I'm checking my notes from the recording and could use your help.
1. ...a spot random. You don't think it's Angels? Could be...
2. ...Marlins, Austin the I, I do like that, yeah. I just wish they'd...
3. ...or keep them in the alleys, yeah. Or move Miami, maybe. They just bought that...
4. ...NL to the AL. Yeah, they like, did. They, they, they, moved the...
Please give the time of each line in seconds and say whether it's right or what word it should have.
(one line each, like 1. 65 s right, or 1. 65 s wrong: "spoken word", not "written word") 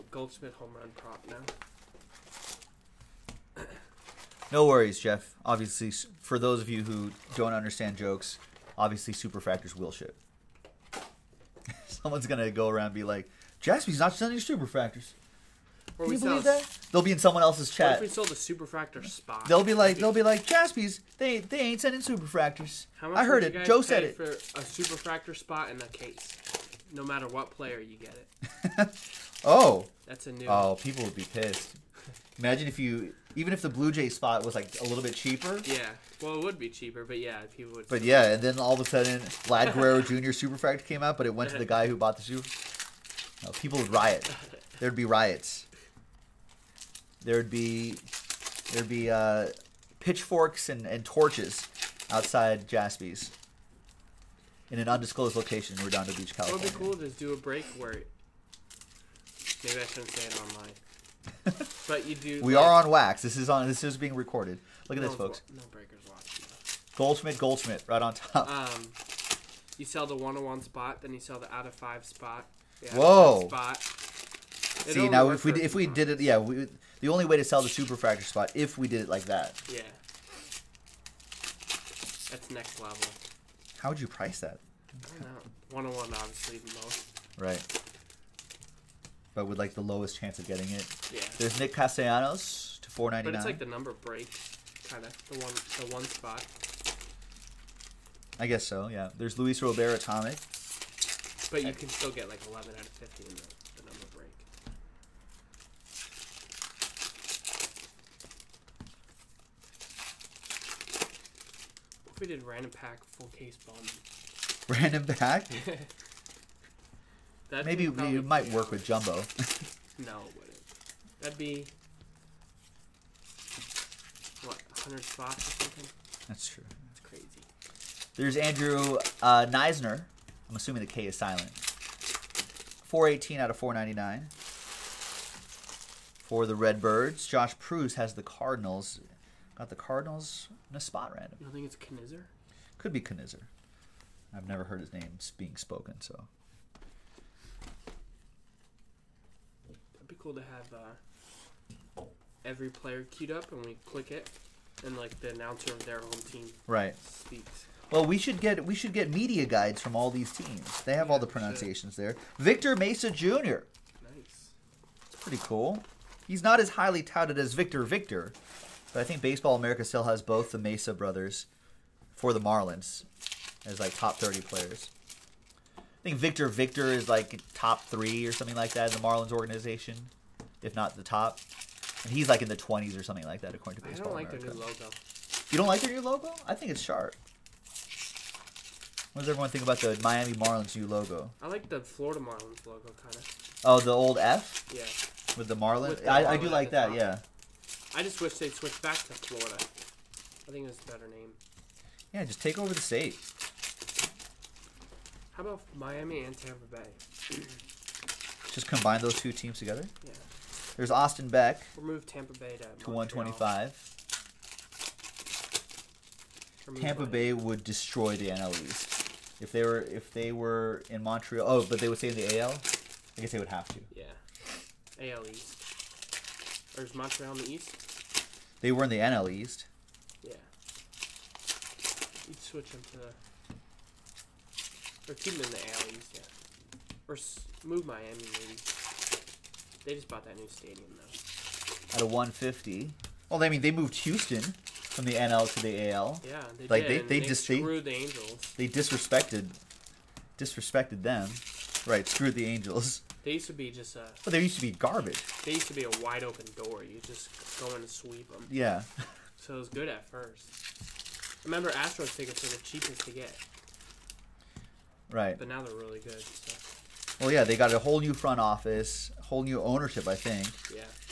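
1. 140 s wrong: "Knizner", not "Angels"
2. 195 s wrong: "With", not "Austin"
3. 235 s right
4. 245 s wrong: "screwed", not "moved".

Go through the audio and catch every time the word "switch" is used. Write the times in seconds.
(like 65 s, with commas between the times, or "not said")
198 s, 232 s.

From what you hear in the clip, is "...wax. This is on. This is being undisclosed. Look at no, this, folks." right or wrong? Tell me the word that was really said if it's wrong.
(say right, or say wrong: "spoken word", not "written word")
wrong: "recorded", not "undisclosed".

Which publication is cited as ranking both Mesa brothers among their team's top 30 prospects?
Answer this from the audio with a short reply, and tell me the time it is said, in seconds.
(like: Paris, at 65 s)
Baseball America, at 169 s.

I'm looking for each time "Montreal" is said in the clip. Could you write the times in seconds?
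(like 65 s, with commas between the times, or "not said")
221 s, 226 s.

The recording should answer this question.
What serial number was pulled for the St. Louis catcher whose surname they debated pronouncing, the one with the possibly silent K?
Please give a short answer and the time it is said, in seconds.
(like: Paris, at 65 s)
418, at 131 s.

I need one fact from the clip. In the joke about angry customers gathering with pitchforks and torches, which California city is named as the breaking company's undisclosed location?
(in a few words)
Redondo Beach.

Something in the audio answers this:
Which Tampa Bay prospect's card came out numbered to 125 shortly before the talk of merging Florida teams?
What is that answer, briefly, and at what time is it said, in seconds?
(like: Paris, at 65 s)
Austin Beck, at 210 s.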